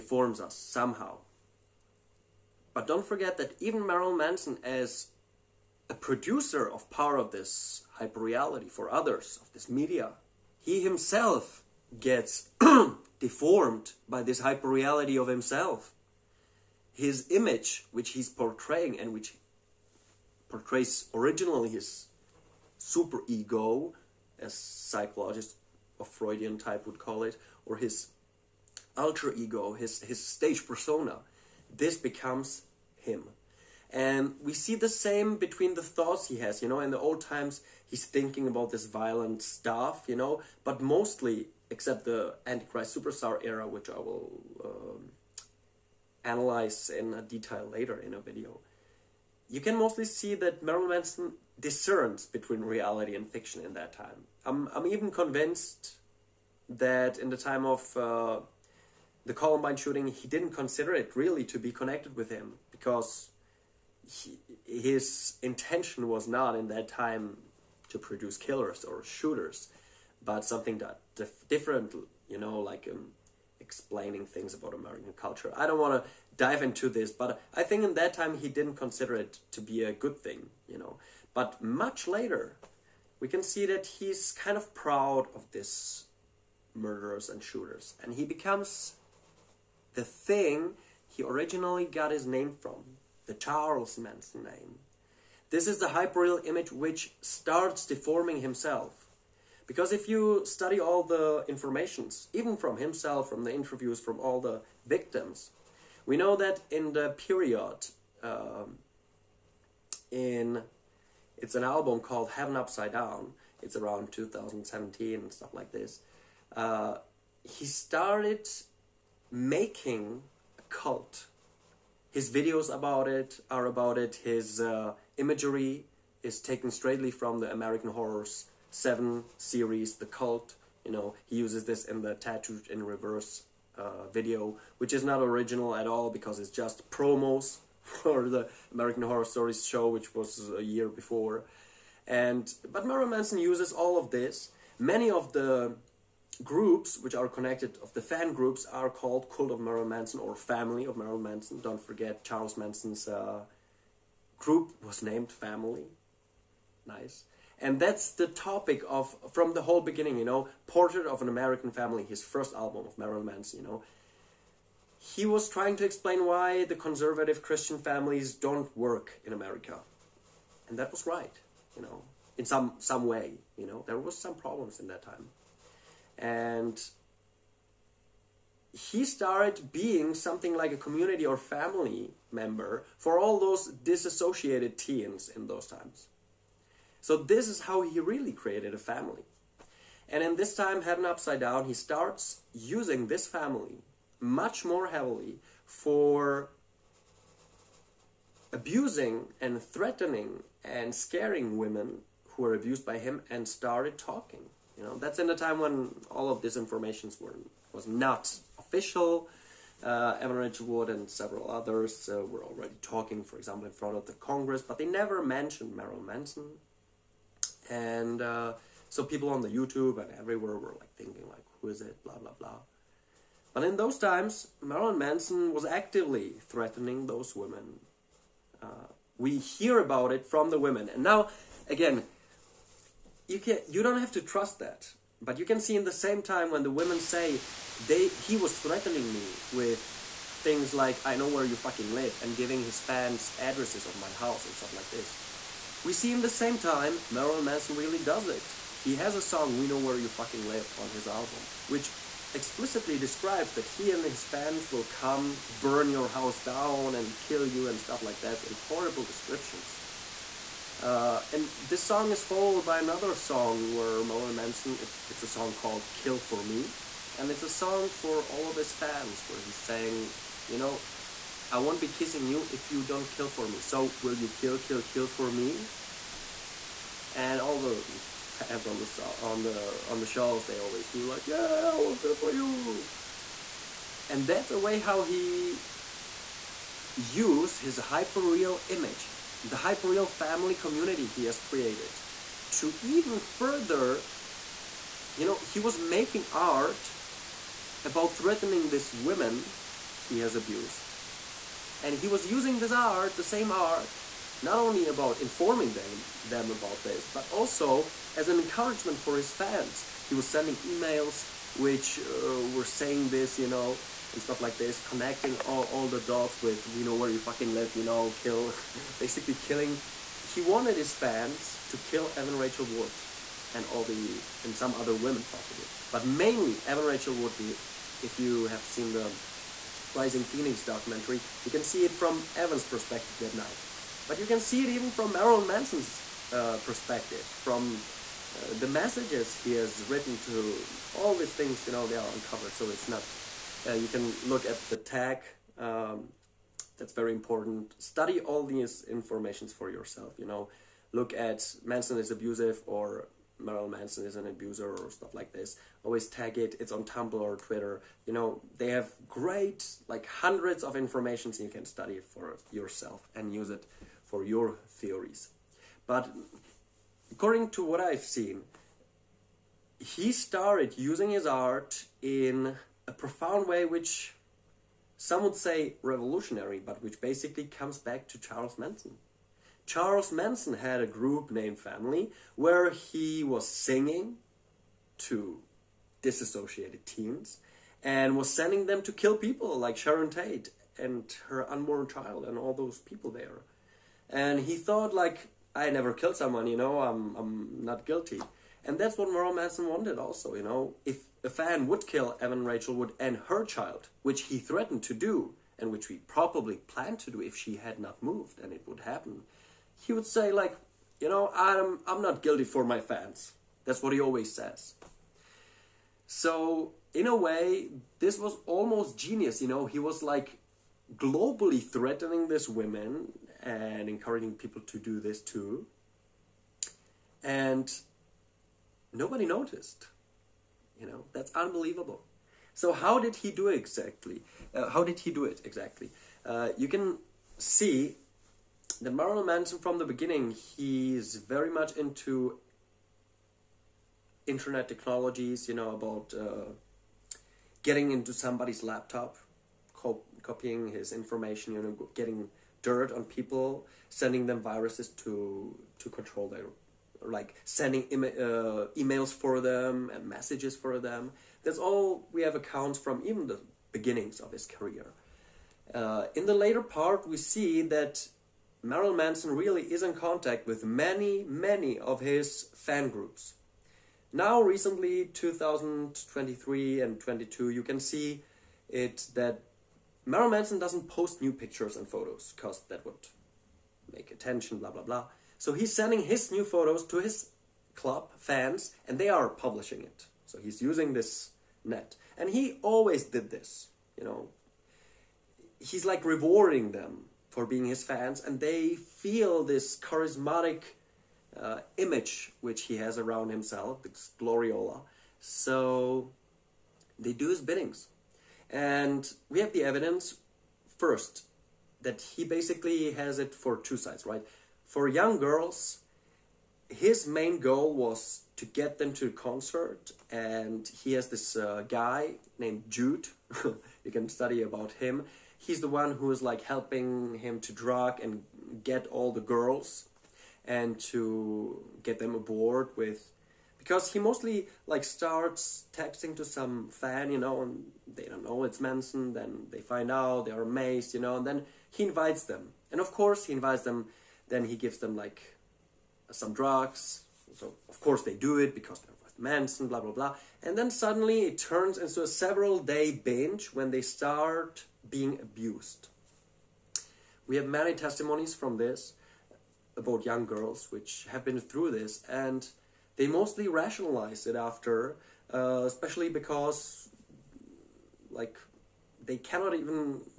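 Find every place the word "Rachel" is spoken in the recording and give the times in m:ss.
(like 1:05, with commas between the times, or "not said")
3:30, 5:22, 5:26, 6:42.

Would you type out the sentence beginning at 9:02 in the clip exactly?
And of course, he invites them then he gives them like some drugs.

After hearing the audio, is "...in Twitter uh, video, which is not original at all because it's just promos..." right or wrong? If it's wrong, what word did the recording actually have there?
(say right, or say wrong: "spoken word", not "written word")
wrong: "Reverse", not "Twitter".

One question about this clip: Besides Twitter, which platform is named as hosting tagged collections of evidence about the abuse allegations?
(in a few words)
Tumblr.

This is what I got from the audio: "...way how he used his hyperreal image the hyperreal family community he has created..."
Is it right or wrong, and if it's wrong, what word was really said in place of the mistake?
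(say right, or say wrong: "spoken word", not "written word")
right.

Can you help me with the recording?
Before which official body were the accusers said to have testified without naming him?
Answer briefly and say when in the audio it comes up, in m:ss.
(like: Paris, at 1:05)
Congress, at 3:34.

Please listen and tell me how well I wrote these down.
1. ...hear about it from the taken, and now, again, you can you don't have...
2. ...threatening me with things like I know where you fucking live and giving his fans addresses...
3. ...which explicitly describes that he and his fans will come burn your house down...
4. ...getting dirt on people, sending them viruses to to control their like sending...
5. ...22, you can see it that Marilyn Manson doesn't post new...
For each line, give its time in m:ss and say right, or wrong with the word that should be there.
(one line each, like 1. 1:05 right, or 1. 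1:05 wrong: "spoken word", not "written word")
1. 3:49 wrong: "women", not "taken"
2. 3:58 right
3. 4:11 right
4. 7:31 right
5. 7:56 right.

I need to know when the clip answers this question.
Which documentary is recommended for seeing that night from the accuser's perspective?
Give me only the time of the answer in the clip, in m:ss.
5:29.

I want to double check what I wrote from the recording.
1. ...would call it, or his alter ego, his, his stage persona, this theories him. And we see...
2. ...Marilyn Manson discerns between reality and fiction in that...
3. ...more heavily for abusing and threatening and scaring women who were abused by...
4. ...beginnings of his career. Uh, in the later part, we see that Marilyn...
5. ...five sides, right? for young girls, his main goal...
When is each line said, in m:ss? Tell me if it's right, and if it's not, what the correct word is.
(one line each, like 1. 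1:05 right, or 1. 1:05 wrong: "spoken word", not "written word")
1. 0:26 wrong: "becomes", not "theories"
2. 0:50 right
3. 3:14 right
4. 7:43 right
5. 8:33 wrong: "two", not "five".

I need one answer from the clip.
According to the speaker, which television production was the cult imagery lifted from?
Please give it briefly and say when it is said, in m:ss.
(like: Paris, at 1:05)
American Horror Story 7, The Cult, at 2:07.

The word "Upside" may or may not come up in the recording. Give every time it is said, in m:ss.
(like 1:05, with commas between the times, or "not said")
1:52, 3:11.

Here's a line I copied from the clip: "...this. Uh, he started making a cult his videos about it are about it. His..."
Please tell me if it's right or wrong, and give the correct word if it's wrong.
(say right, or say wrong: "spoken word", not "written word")
right.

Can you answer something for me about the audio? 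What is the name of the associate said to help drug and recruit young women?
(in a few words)
Jude.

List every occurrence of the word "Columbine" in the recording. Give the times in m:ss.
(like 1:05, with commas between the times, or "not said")
0:59.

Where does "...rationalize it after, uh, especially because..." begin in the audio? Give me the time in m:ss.
9:23.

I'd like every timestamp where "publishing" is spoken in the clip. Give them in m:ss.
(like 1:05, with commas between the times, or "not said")
8:09.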